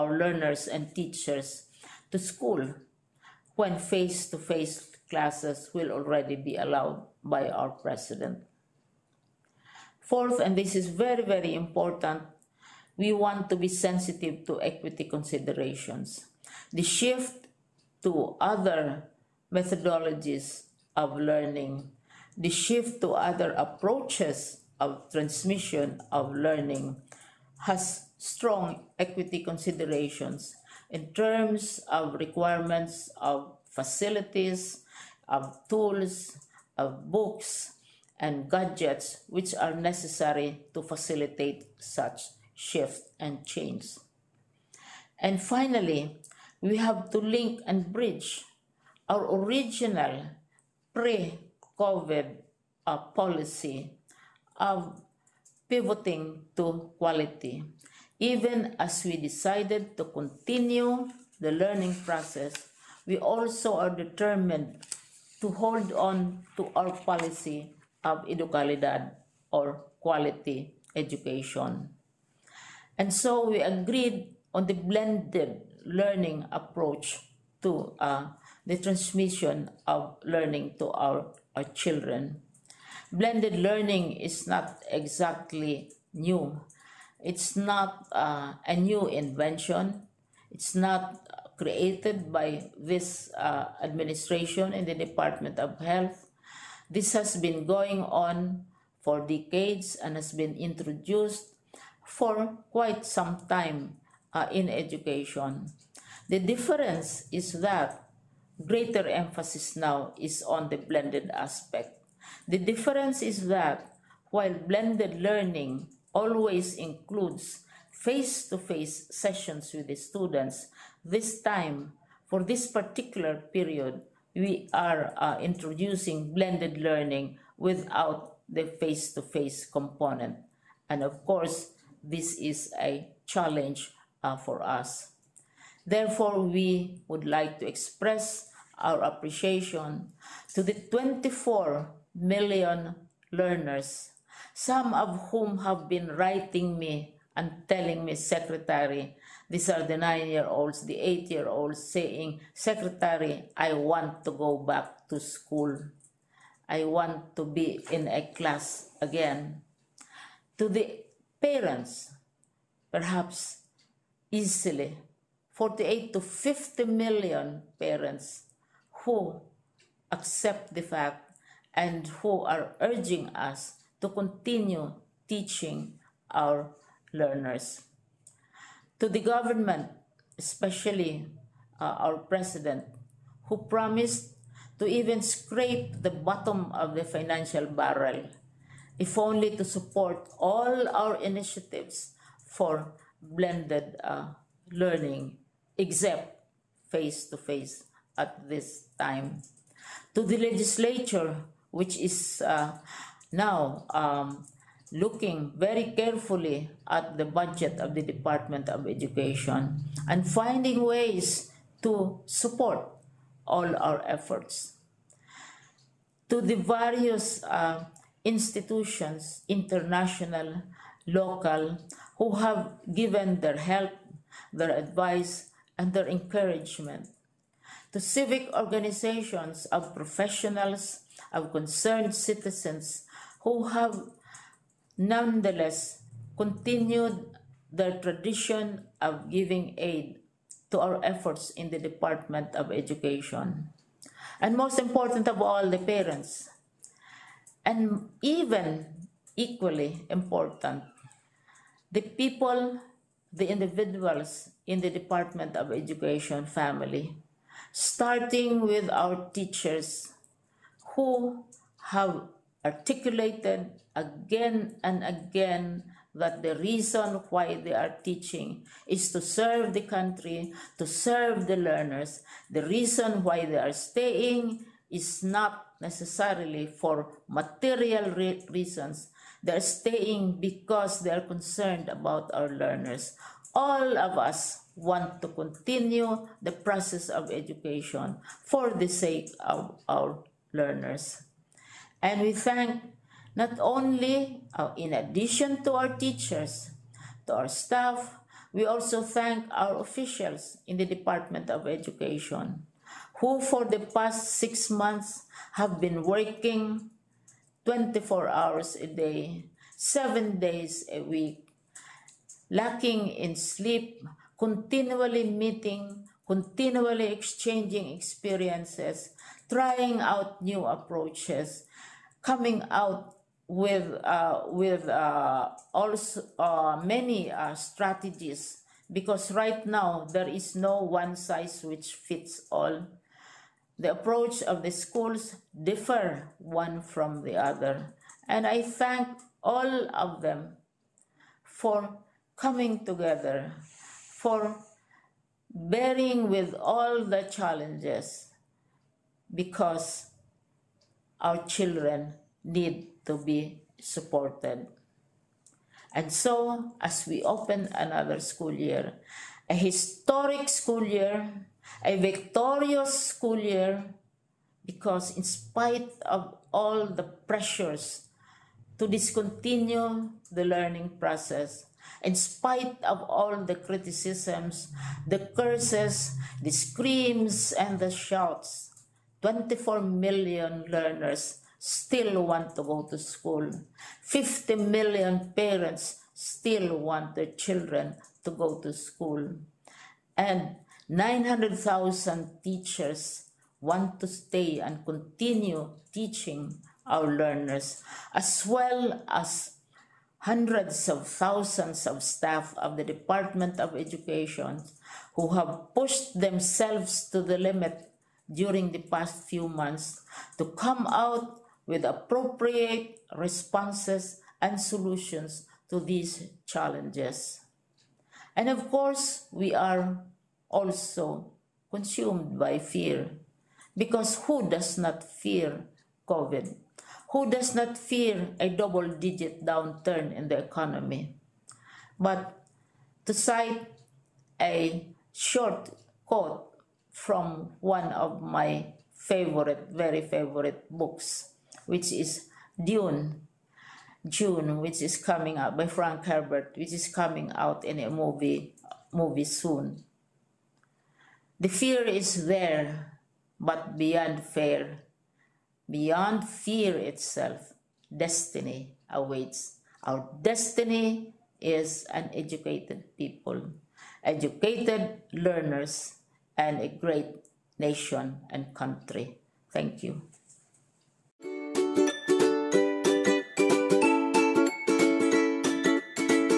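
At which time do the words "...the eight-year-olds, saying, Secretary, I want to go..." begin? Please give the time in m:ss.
2:30.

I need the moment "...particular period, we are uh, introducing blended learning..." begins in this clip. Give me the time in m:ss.
2:02.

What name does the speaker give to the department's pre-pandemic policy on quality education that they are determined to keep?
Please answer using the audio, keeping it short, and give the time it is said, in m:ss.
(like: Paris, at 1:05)
EduKalidad, at 1:08.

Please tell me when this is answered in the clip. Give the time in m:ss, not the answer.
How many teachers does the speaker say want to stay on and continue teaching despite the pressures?
6:30.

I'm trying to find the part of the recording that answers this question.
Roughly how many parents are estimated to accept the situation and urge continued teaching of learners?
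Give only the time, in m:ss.
2:45.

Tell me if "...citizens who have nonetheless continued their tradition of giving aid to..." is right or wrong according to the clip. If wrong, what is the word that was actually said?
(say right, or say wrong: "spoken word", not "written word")
right.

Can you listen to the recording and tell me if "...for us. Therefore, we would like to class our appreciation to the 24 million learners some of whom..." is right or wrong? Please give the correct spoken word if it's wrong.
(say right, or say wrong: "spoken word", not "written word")
wrong: "express", not "class".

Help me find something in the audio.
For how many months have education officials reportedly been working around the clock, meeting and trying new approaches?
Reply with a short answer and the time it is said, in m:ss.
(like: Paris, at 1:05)
6, at 5:04.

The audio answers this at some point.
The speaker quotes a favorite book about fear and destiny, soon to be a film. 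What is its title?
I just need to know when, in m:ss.
7:22.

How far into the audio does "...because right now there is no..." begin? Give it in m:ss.
5:28.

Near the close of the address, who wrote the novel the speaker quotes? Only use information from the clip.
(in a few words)
Frank Herbert.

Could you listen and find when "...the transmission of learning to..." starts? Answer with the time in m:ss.
1:18.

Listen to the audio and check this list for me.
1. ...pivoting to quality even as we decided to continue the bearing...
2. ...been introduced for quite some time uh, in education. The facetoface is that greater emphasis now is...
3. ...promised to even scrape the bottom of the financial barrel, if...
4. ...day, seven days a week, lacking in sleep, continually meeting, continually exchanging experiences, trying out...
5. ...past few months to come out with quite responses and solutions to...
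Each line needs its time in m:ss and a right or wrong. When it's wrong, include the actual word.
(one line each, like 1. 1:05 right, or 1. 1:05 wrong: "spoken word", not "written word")
1. 0:55 wrong: "learning", not "bearing"
2. 1:40 wrong: "difference", not "facetoface"
3. 3:03 right
4. 5:08 right
5. 6:48 wrong: "appropriate", not "quite".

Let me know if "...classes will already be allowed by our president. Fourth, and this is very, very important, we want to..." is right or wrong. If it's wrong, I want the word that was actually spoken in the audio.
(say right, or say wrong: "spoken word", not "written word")
right.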